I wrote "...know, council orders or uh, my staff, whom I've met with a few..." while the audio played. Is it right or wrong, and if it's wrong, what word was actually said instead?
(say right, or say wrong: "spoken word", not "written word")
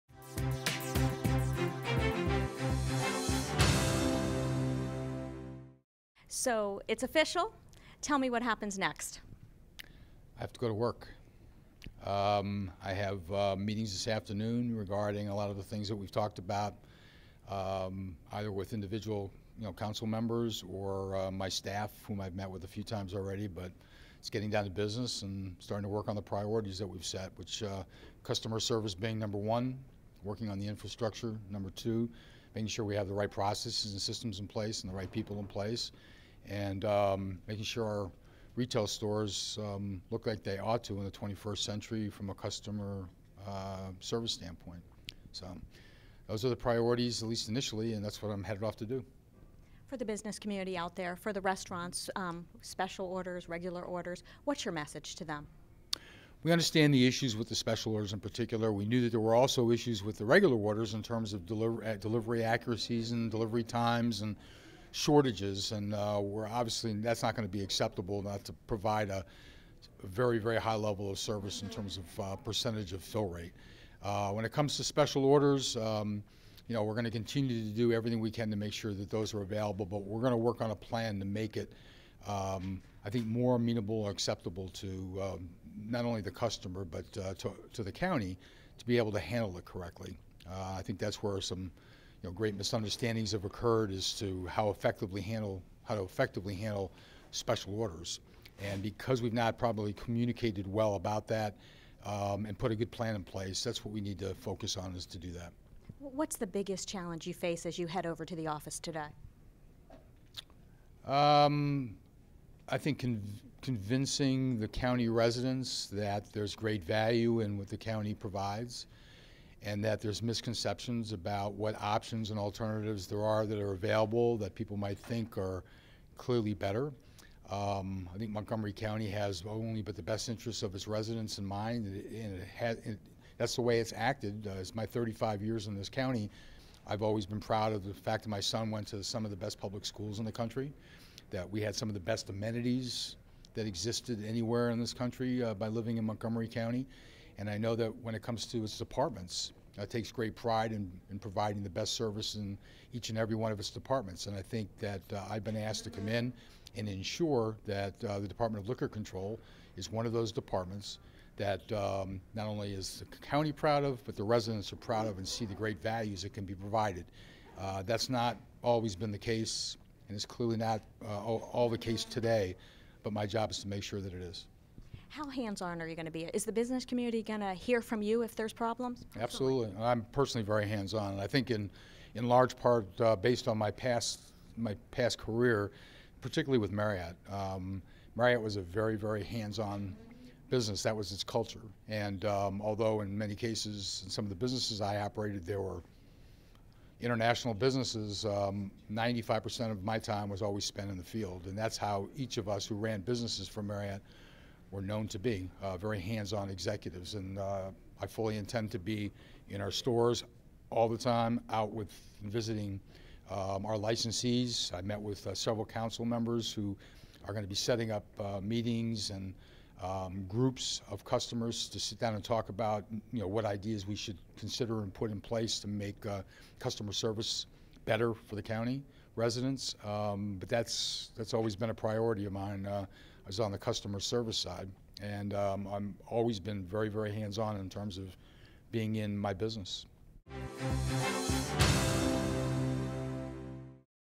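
wrong: "members", not "orders".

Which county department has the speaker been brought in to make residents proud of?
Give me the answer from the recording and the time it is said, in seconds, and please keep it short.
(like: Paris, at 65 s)
Department of Liquor Control, at 158 s.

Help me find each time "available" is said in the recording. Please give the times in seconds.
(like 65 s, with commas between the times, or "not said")
79 s, 123 s.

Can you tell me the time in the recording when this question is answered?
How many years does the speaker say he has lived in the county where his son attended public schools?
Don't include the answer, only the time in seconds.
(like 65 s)
134 s.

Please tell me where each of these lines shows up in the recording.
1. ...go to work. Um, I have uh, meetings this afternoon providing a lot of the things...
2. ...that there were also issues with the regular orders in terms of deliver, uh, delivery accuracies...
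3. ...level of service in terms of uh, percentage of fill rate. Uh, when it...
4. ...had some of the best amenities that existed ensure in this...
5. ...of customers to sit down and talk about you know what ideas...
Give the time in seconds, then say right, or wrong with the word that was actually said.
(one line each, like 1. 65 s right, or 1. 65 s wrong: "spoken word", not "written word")
1. 10 s wrong: "regarding", not "providing"
2. 59 s right
3. 70 s right
4. 141 s wrong: "anywhere", not "ensure"
5. 220 s right.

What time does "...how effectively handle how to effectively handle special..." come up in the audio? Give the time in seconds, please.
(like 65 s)
94 s.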